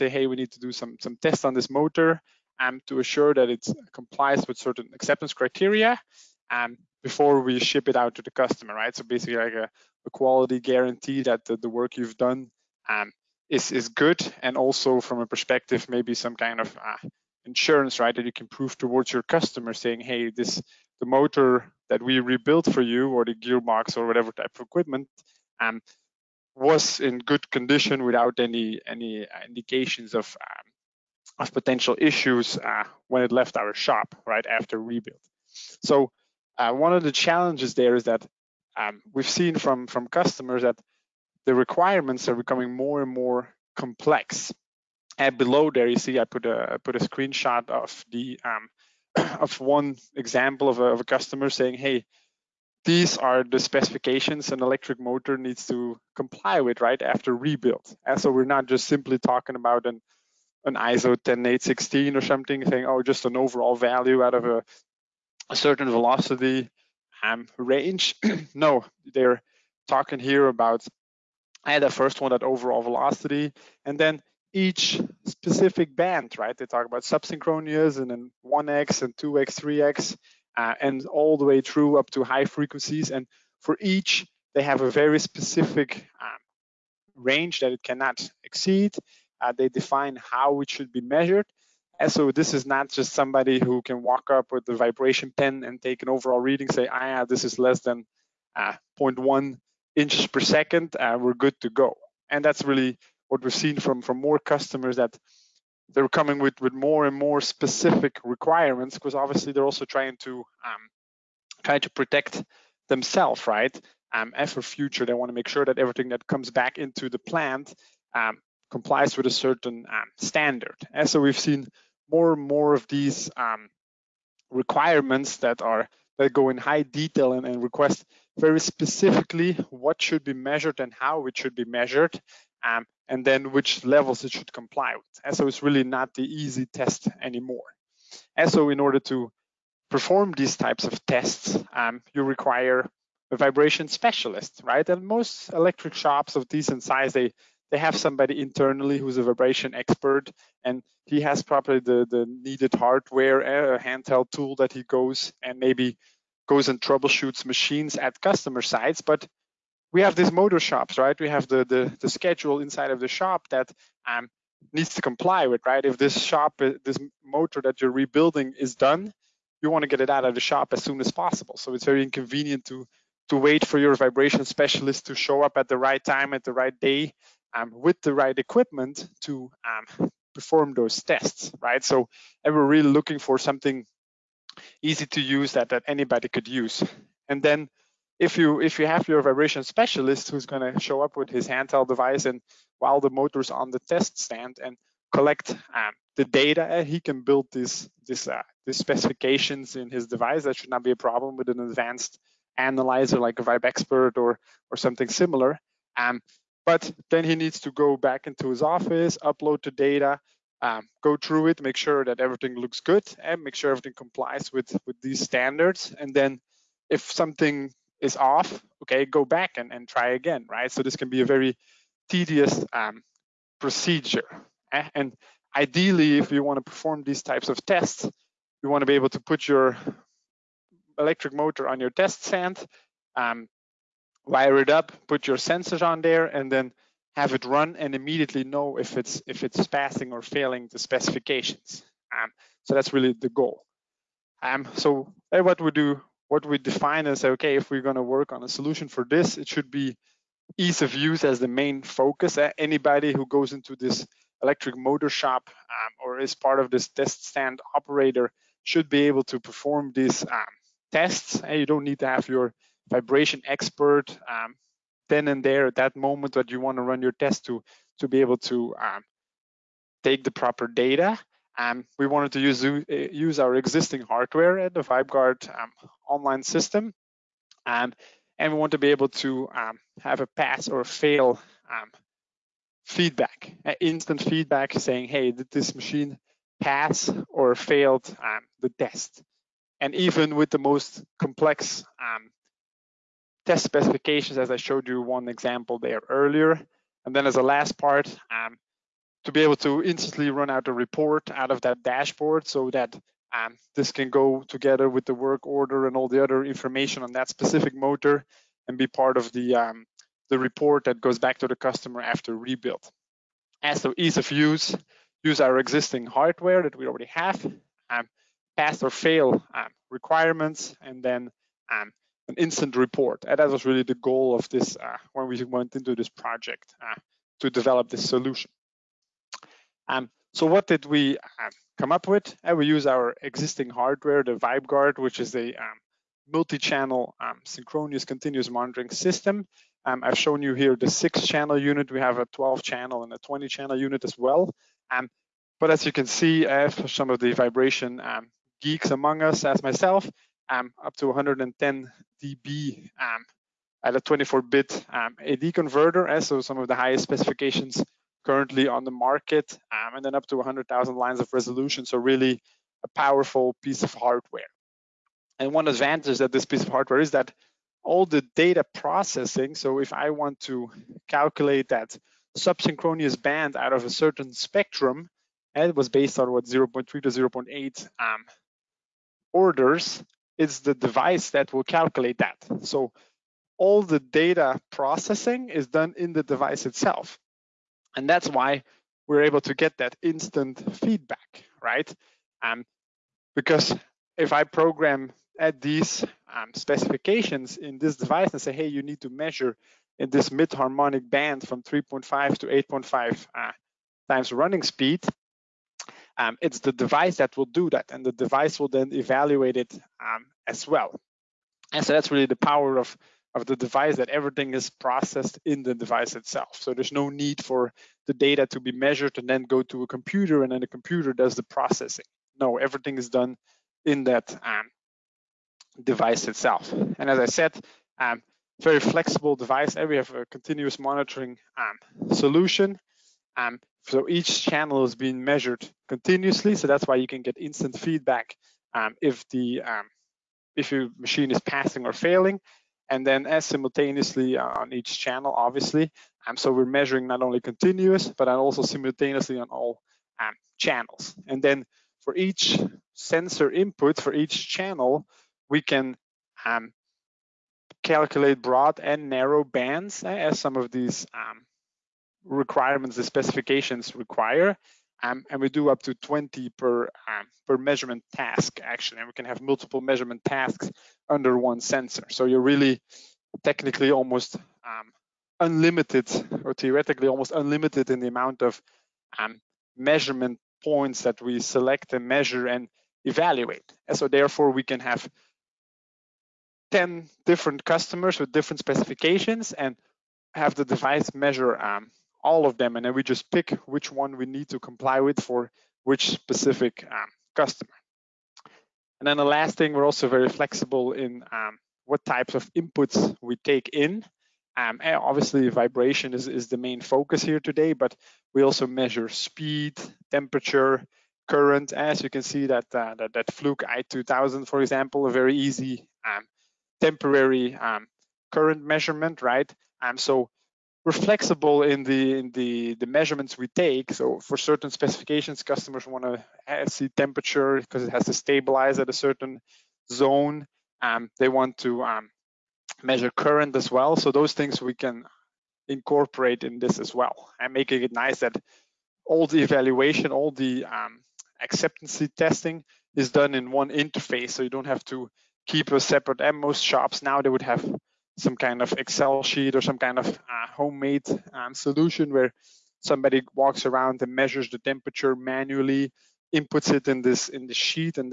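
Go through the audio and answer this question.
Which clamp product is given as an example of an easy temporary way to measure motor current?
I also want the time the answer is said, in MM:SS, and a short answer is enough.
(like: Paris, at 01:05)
Fluke i2000, at 08:33.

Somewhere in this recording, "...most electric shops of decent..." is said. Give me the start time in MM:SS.
02:25.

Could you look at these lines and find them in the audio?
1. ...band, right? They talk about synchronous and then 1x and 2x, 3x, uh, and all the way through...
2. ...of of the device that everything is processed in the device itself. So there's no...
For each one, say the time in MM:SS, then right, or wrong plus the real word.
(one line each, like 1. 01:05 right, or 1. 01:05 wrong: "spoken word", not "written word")
1. 01:15 wrong: "subsynchronous", not "synchronous"
2. 06:52 right.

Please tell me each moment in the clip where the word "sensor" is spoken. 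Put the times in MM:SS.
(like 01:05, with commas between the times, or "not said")
03:55, 07:32, 07:51.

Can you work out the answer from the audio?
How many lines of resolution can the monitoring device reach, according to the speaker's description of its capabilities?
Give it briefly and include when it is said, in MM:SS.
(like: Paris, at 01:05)
100,000, at 06:00.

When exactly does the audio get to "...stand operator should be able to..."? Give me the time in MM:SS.
04:17.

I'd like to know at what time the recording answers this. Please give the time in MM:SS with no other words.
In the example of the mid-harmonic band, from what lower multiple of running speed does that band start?
06:41.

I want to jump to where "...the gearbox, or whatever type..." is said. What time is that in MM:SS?
00:23.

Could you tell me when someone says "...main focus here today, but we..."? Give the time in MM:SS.
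08:26.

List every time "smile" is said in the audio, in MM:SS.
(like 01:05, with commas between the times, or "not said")
not said.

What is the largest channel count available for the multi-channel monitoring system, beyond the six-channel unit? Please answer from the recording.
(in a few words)
20.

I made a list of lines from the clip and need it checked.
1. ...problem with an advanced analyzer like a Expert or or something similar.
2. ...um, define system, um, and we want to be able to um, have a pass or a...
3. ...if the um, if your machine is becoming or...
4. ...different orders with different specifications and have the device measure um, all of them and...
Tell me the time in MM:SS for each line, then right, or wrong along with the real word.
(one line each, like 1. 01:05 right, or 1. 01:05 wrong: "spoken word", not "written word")
1. 03:20 right
2. 04:35 wrong: "online", not "define"
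3. 07:18 wrong: "passing", not "becoming"
4. 08:07 wrong: "customers", not "orders".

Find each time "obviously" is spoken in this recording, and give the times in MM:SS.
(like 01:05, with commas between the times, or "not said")
01:49, 07:25, 08:24.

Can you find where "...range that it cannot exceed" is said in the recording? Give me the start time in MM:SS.
01:27.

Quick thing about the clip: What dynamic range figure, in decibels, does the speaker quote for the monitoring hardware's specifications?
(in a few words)
110 dB.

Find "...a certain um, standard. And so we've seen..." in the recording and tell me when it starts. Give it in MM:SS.
01:59.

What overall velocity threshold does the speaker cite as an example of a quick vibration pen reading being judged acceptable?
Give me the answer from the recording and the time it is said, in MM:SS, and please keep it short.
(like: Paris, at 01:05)
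0.1 inches per second, at 01:38.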